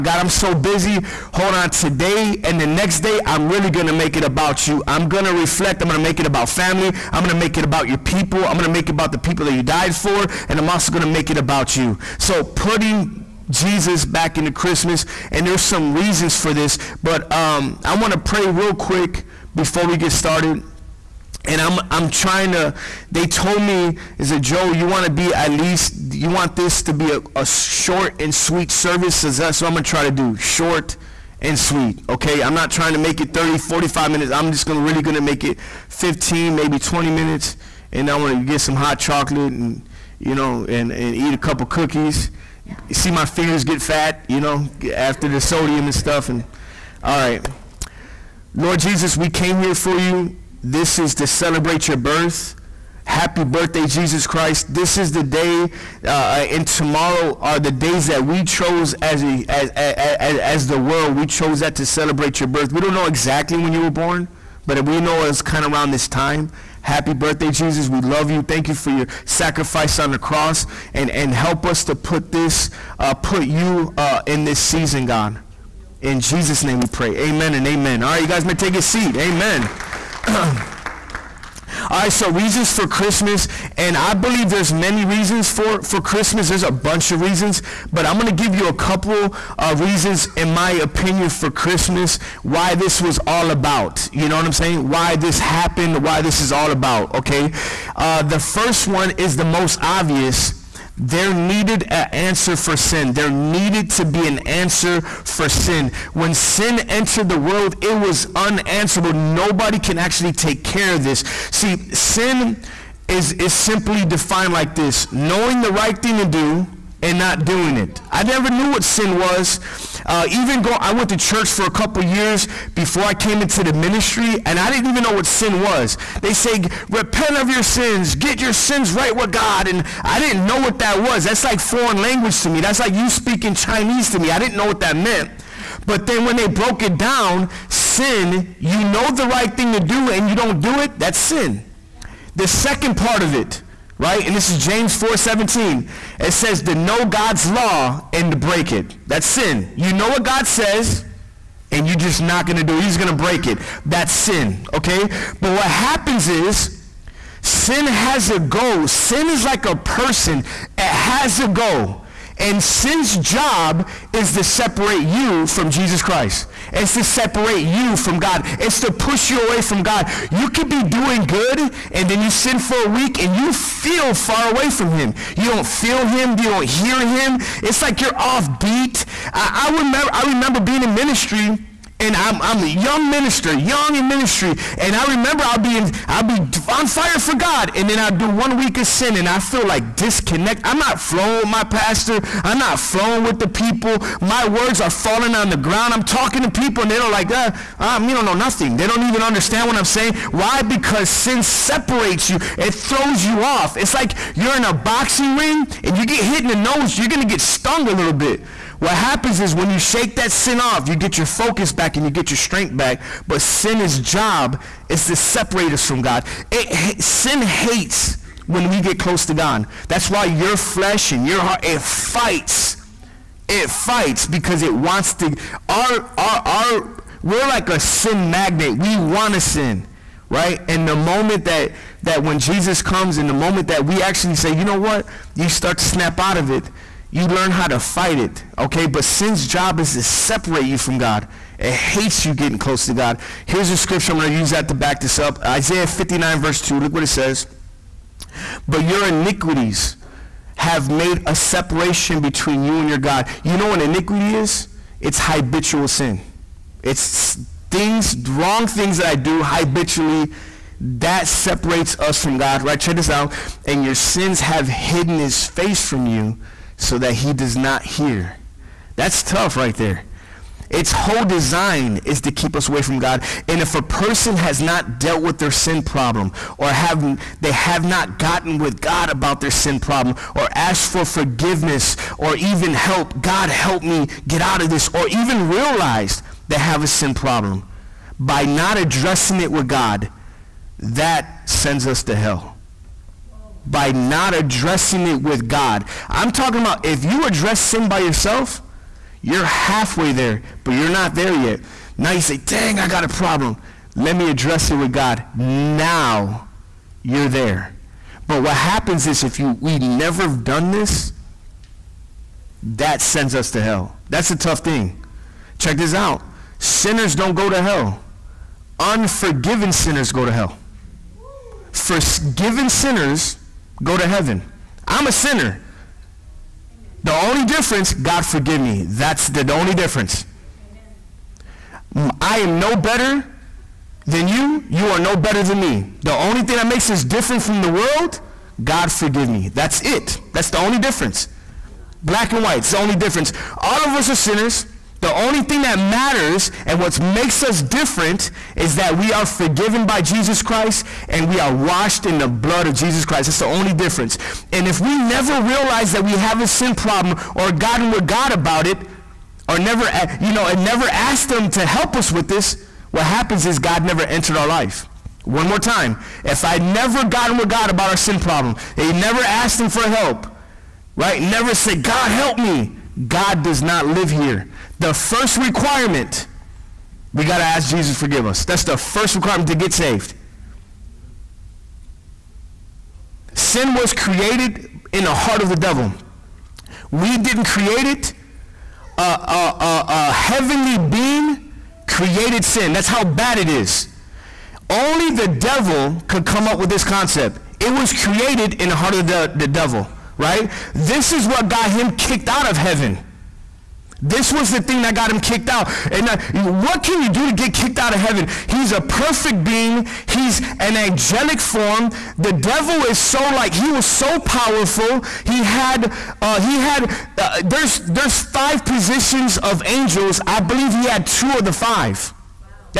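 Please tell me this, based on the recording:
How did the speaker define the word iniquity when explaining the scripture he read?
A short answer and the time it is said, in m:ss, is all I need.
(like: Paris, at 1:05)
habitual sin, at 4:15.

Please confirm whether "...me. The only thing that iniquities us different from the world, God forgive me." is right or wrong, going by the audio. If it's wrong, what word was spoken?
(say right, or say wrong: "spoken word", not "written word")
wrong: "makes", not "iniquities".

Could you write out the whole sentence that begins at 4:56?
I'm talking about if you address sin by yourself, you're halfway there, but you're not there yet.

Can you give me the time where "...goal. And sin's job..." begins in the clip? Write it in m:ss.
2:41.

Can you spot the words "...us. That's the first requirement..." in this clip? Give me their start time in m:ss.
6:18.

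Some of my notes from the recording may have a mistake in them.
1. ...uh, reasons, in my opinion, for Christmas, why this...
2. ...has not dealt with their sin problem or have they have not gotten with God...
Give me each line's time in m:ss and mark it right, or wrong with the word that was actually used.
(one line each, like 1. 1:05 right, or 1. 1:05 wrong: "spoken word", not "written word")
1. 1:29 right
2. 4:34 right.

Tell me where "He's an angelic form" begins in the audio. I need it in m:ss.
6:50.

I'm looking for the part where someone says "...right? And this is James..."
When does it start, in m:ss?
2:24.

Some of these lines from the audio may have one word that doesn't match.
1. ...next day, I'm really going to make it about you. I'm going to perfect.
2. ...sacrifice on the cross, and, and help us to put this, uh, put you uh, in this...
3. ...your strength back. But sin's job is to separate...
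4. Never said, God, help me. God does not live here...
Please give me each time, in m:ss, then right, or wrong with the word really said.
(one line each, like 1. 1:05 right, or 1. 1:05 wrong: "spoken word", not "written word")
1. 0:02 wrong: "reflect", not "perfect"
2. 1:09 right
3. 3:32 right
4. 6:11 right.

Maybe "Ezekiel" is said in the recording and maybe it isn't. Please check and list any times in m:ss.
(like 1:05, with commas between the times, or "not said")
not said.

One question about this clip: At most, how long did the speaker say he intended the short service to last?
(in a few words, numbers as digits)
20 minutes.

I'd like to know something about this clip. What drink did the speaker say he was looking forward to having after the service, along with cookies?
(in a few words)
hot chocolate.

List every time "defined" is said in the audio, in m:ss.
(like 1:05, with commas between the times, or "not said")
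1:54.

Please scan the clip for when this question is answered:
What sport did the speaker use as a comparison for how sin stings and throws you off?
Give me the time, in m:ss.
3:24.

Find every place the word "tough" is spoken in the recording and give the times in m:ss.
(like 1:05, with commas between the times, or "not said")
4:29, 5:14.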